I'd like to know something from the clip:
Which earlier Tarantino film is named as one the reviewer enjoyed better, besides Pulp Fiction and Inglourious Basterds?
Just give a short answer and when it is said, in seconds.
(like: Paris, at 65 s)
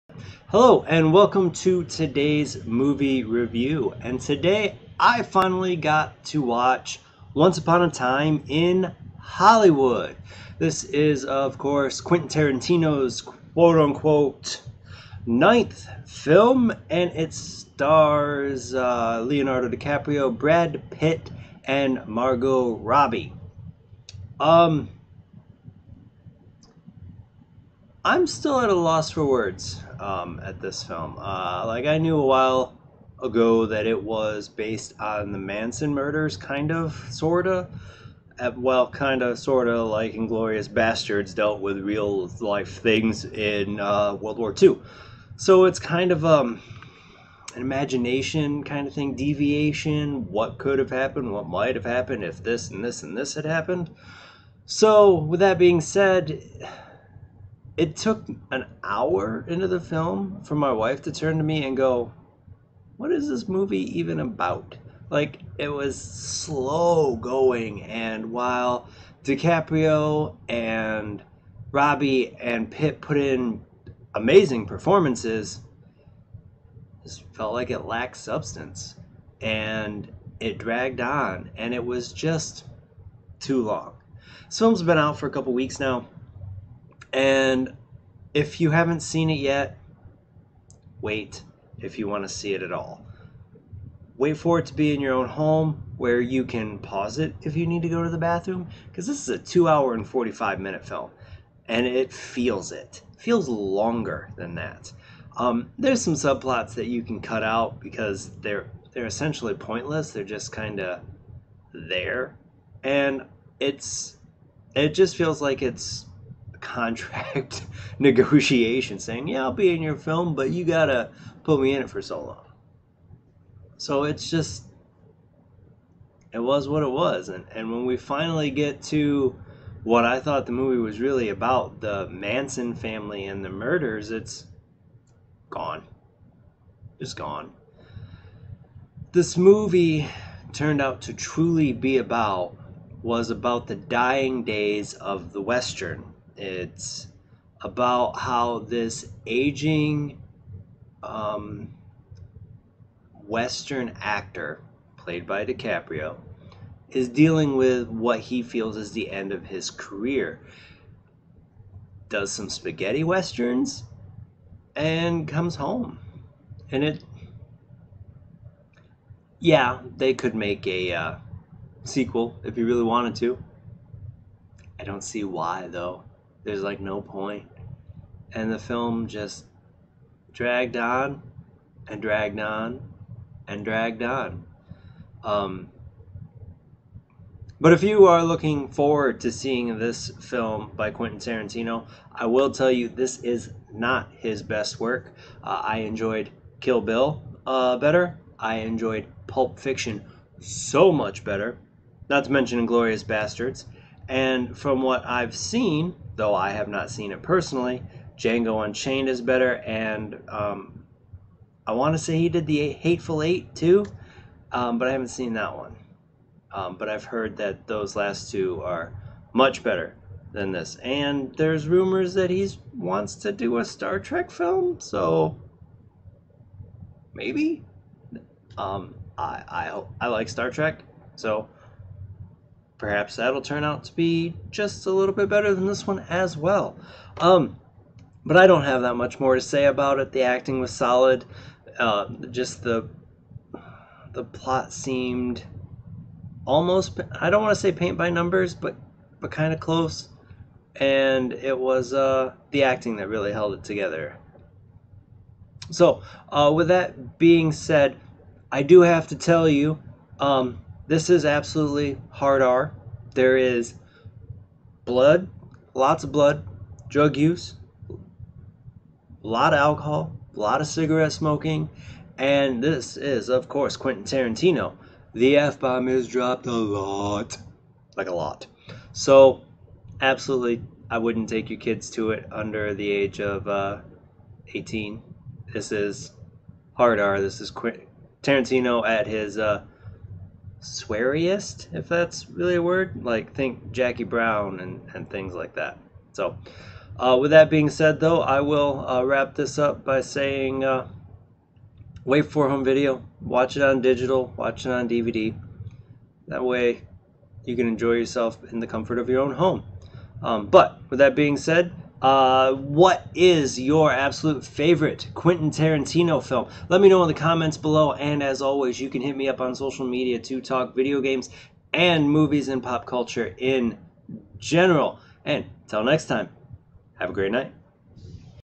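Kill Bill, at 196 s.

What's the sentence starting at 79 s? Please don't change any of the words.
And it dragged on, and it was just too long.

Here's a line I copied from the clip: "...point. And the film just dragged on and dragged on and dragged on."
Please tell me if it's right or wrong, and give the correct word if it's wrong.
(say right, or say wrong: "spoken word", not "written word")
right.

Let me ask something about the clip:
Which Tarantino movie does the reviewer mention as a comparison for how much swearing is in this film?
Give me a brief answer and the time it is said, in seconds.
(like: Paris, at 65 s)
Jackie Brown, at 293 s.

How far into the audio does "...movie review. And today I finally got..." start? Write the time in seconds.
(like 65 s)
2 s.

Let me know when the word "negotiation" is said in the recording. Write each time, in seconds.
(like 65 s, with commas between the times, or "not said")
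117 s.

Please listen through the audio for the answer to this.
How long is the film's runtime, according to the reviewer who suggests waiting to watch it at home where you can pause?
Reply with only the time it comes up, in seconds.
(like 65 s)
99 s.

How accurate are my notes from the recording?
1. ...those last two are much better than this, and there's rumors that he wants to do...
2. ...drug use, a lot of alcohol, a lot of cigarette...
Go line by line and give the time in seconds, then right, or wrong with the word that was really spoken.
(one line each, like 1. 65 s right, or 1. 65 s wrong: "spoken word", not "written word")
1. 217 s right
2. 266 s right.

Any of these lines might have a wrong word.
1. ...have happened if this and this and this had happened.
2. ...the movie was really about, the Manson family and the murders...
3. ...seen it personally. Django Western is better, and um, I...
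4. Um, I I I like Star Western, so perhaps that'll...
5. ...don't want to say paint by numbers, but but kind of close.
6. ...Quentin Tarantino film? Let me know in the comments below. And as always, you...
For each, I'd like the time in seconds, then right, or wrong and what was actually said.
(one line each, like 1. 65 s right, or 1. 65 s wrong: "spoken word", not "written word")
1. 51 s right
2. 130 s right
3. 206 s wrong: "Unchained", not "Western"
4. 228 s wrong: "Trek", not "Western"
5. 247 s right
6. 315 s right.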